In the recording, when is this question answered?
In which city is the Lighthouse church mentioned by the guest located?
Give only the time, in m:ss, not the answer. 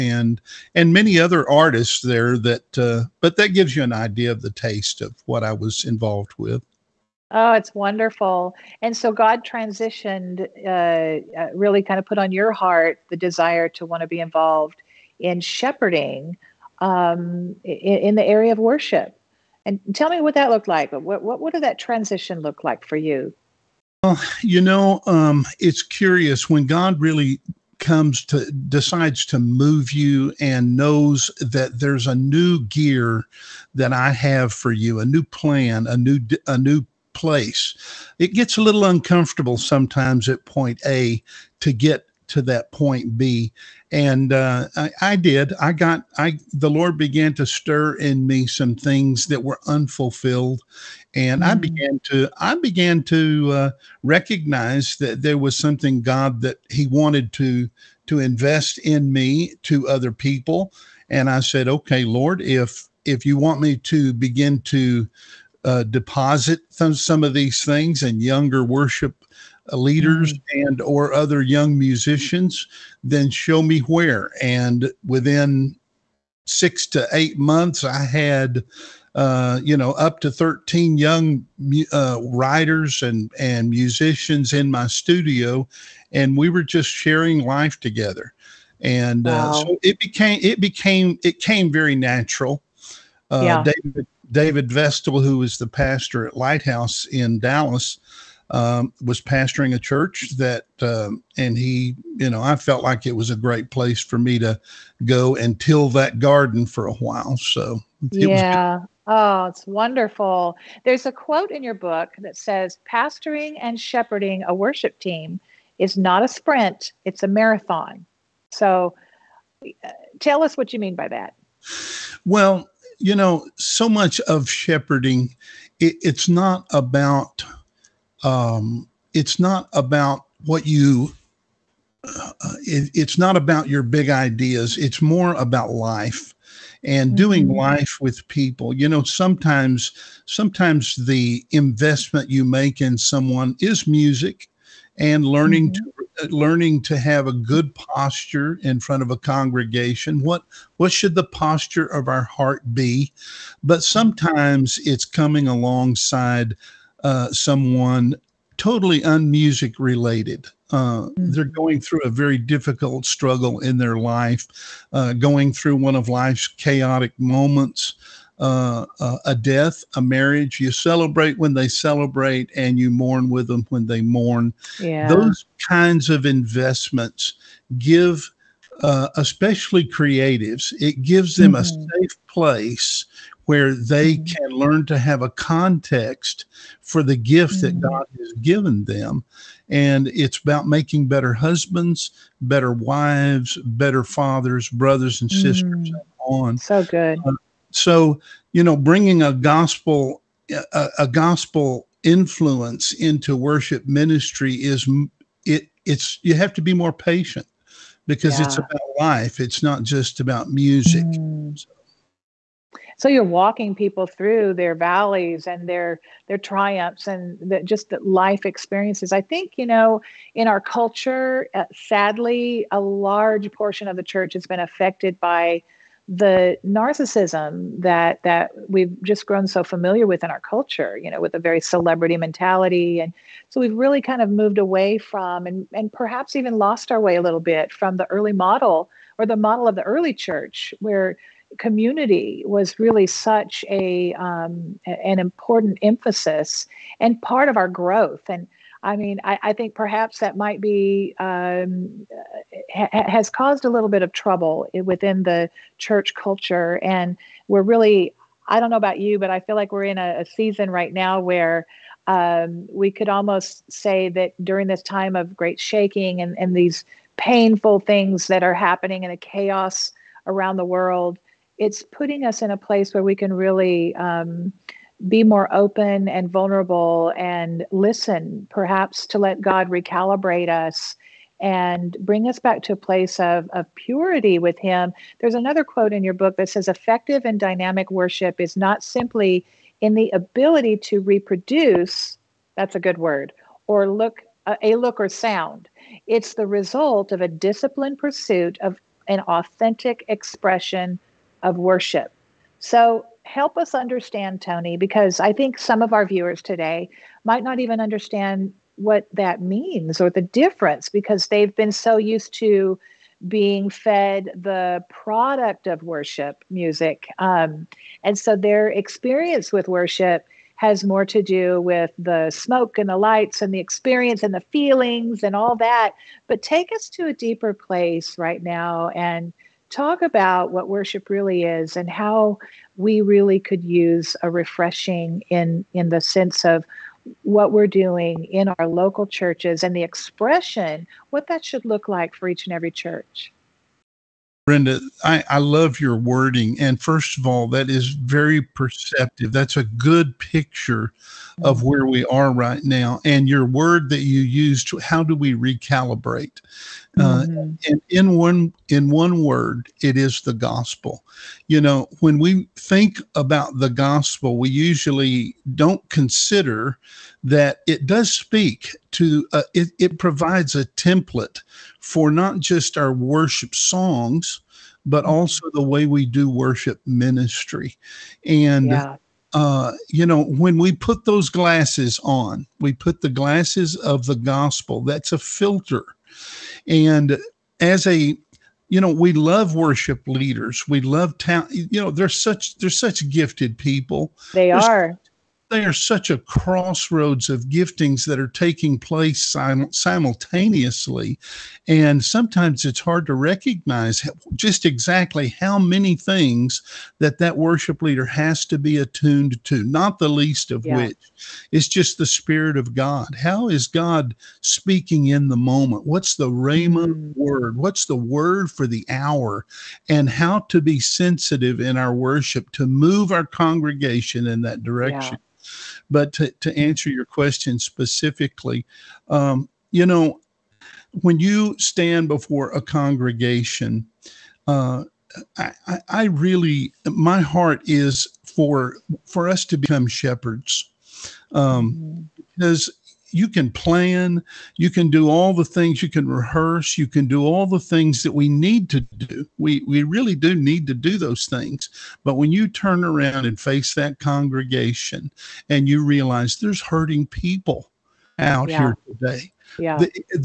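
1:37.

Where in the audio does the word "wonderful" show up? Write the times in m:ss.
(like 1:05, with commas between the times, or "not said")
0:07, 1:49.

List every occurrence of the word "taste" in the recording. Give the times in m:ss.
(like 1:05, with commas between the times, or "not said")
0:04.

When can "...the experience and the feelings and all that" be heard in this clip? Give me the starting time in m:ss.
5:23.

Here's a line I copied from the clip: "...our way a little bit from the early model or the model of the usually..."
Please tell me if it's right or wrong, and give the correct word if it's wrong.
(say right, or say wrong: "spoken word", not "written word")
wrong: "early", not "usually".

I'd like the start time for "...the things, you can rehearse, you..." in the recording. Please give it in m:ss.
7:25.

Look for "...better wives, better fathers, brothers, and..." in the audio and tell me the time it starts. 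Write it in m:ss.
3:12.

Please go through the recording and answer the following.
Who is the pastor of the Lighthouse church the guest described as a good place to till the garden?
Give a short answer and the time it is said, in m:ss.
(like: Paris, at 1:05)
David Vestal, at 1:34.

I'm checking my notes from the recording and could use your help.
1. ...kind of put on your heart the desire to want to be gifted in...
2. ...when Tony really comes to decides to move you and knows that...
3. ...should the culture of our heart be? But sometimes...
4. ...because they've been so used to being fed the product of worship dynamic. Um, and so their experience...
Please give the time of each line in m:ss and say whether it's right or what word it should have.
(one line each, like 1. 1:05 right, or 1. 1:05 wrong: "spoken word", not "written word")
1. 0:11 wrong: "involved", not "gifted"
2. 0:26 wrong: "God", not "Tony"
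3. 2:30 wrong: "posture", not "culture"
4. 5:10 wrong: "music", not "dynamic".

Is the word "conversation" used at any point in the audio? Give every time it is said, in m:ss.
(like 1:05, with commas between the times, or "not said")
not said.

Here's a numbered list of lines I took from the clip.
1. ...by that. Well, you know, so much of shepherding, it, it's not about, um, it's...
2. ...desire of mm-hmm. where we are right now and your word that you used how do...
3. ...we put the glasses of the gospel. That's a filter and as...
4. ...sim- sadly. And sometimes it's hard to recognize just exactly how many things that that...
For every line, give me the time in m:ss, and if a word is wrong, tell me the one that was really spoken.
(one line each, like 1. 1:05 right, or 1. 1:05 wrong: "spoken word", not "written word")
1. 2:00 right
2. 5:50 wrong: "picture", not "desire"
3. 6:22 right
4. 6:39 wrong: "simultaneously", not "sadly".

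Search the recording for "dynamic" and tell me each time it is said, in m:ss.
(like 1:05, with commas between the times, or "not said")
4:47.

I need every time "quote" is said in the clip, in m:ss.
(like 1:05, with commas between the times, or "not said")
1:51, 4:45.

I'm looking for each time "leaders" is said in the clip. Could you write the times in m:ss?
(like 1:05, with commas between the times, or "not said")
1:09, 6:30, 6:47.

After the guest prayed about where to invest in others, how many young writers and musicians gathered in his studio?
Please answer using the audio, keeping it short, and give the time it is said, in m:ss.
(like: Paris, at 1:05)
13, at 1:20.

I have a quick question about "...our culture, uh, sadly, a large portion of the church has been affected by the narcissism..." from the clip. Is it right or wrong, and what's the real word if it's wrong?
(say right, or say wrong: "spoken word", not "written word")
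right.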